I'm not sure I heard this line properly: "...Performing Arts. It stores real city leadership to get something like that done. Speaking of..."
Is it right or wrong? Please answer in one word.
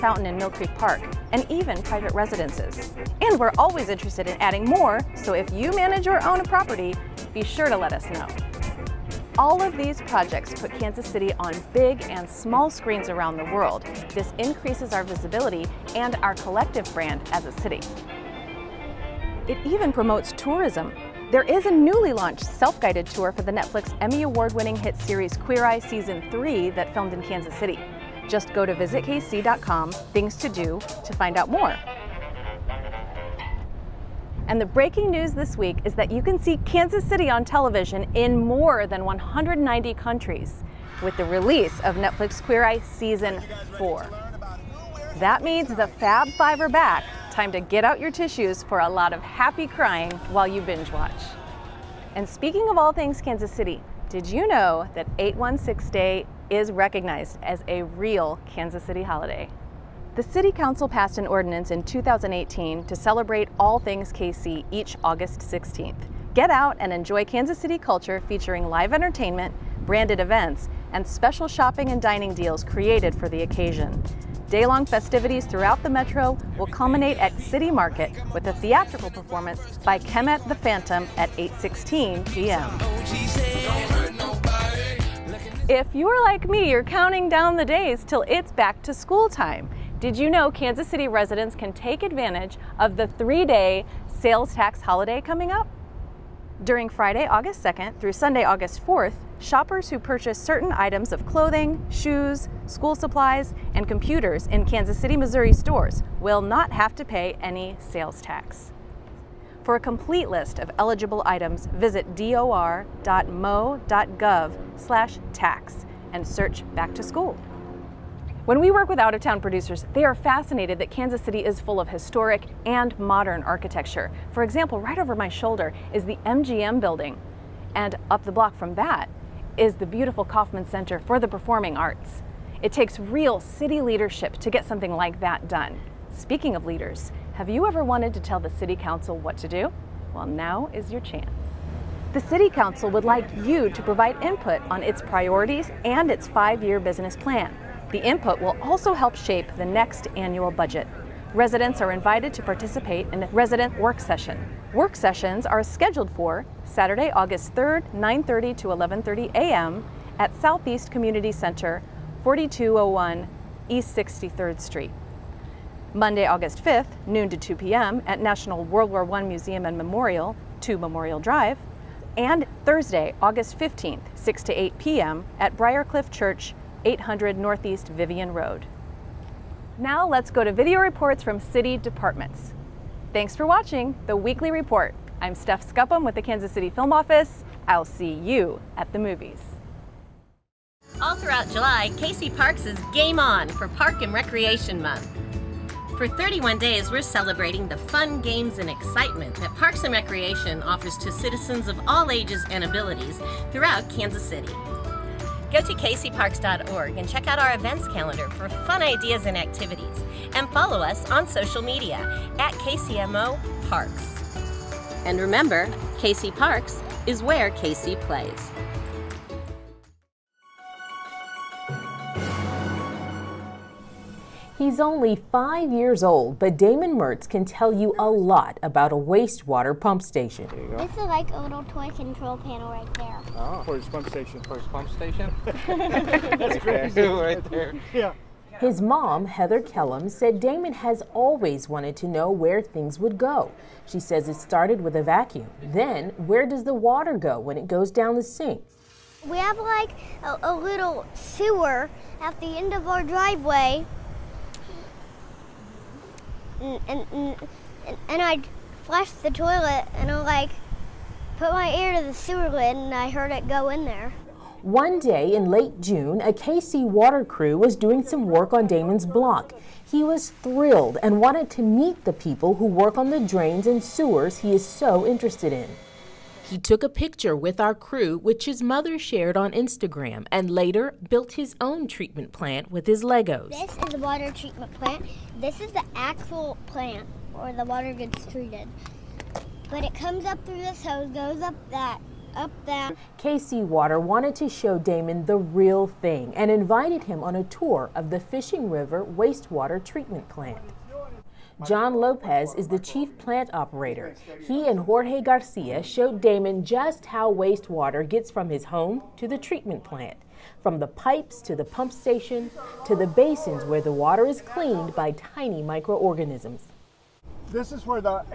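wrong.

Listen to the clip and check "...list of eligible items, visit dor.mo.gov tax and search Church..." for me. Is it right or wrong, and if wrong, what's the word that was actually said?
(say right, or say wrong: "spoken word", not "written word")
wrong: "Back", not "Church".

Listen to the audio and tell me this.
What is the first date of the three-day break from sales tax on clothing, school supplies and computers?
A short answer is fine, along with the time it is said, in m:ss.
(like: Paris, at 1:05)
Friday, August 2nd, at 1:36.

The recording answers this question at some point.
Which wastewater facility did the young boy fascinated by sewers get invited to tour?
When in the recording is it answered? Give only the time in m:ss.
4:58.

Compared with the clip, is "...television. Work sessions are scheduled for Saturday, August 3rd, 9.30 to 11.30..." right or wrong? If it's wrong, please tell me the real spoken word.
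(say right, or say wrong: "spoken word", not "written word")
wrong: "session", not "television".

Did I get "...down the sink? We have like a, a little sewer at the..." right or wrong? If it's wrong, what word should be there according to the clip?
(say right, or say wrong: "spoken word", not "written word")
right.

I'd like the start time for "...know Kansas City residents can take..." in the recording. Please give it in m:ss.
1:30.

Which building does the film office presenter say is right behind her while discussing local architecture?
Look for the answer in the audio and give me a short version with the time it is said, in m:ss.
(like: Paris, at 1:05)
MGM building, at 2:06.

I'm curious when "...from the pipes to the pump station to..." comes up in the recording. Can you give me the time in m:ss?
5:10.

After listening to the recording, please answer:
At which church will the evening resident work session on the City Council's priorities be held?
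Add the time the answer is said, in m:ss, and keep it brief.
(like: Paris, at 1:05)
Briarcliff Church, at 2:55.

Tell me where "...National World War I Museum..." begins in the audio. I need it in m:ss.
2:48.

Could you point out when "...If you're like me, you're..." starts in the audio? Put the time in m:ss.
1:25.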